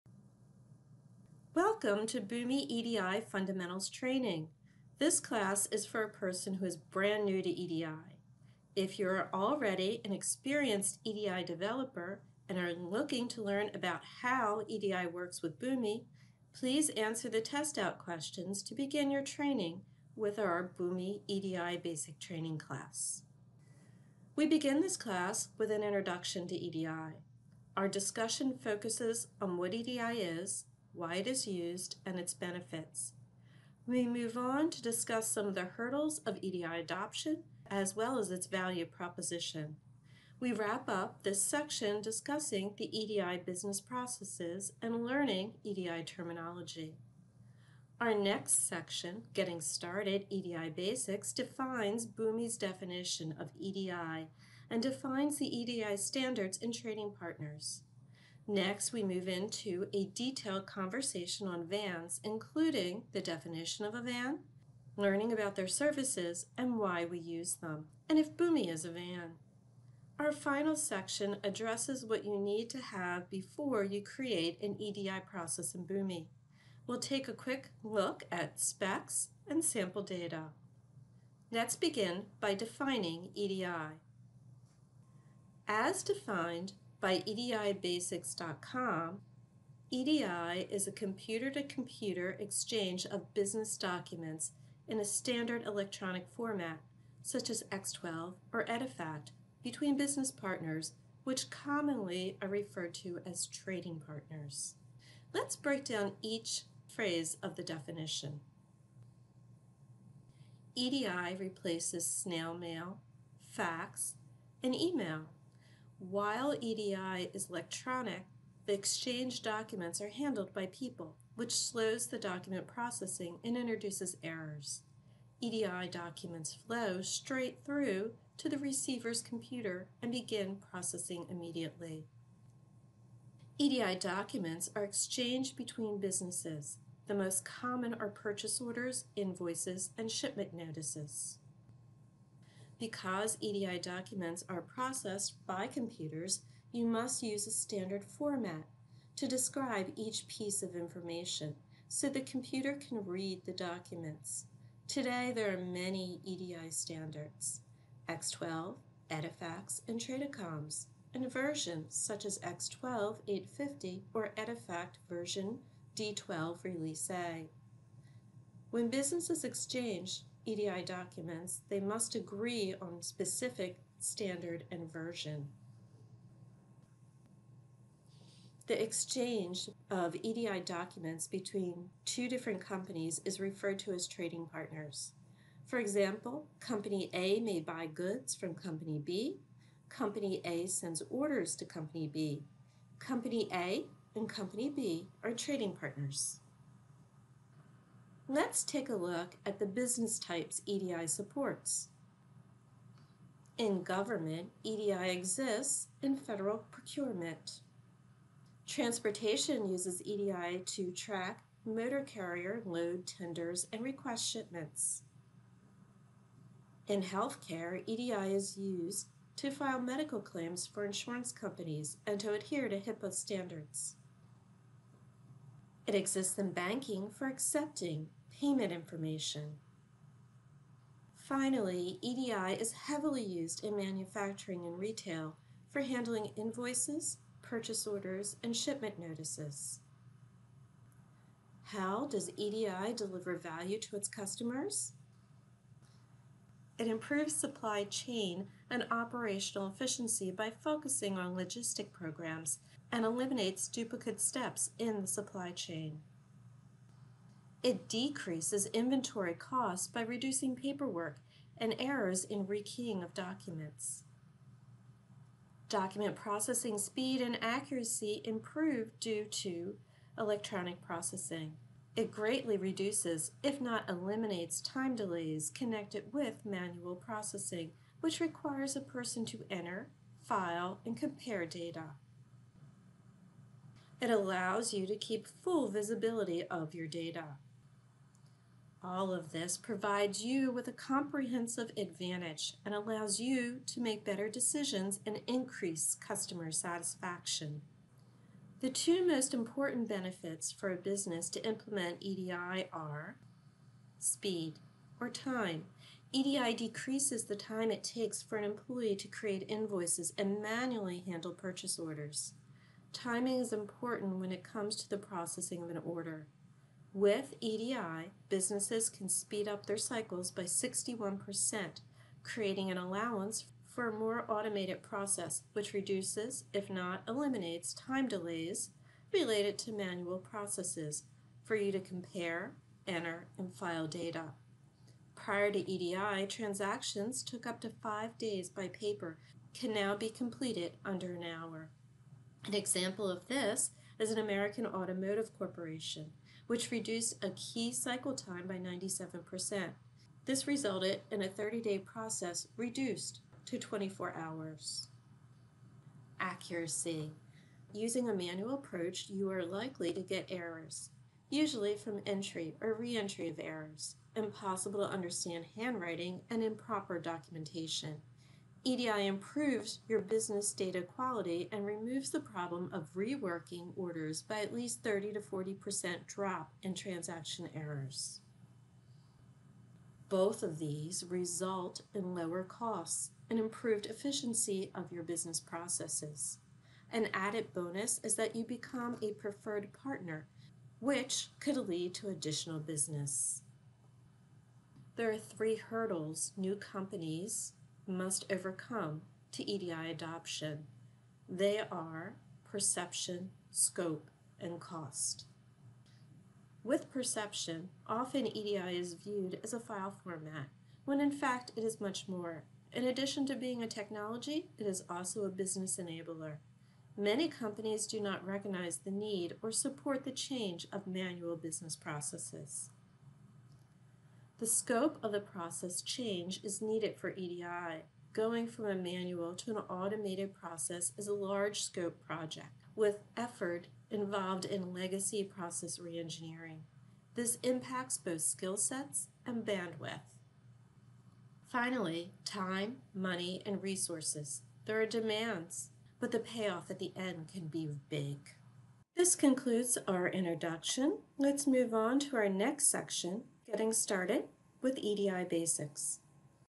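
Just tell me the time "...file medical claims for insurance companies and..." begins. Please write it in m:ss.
3:39.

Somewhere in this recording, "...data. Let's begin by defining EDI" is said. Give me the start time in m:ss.
1:20.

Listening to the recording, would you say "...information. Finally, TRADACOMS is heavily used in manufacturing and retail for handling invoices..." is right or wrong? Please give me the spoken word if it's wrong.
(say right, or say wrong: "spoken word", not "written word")
wrong: "EDI", not "TRADACOMS".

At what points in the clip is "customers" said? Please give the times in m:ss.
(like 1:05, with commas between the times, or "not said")
4:04, 4:55.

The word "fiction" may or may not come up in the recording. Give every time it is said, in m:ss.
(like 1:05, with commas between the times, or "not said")
not said.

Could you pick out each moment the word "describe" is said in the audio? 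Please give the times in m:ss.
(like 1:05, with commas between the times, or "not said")
2:29.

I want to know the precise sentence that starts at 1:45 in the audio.
Let's break down each phrase of the definition.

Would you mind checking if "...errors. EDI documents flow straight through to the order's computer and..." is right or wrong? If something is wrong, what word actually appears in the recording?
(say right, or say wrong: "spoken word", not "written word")
wrong: "receiver", not "order".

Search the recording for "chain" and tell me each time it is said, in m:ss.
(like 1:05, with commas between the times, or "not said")
4:07, 4:15.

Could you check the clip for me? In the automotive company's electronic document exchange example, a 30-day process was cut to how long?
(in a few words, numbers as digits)
24 hours.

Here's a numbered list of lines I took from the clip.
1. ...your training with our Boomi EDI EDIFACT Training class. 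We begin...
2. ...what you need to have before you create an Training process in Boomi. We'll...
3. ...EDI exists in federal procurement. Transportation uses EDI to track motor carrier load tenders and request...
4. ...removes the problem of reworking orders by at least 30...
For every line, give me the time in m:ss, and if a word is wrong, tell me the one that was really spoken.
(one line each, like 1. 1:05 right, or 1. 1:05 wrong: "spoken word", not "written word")
1. 0:19 wrong: "Basic", not "EDIFACT"
2. 1:12 wrong: "EDI", not "Training"
3. 3:24 right
4. 6:11 right.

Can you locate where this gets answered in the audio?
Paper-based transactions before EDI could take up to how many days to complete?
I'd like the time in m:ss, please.
5:37.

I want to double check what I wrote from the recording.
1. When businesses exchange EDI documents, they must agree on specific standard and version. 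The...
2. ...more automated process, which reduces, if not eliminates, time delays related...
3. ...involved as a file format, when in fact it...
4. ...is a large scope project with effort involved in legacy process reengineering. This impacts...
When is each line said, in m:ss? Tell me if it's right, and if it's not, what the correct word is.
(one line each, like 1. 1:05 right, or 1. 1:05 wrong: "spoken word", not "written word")
1. 2:48 right
2. 5:23 right
3. 6:48 wrong: "viewed", not "involved"
4. 7:10 right.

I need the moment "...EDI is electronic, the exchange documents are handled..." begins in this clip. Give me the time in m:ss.
1:56.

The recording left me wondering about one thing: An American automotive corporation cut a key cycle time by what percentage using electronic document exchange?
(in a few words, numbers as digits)
97%.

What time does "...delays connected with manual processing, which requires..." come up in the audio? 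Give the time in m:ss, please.
4:34.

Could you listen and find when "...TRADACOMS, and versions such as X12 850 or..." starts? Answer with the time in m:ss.
2:40.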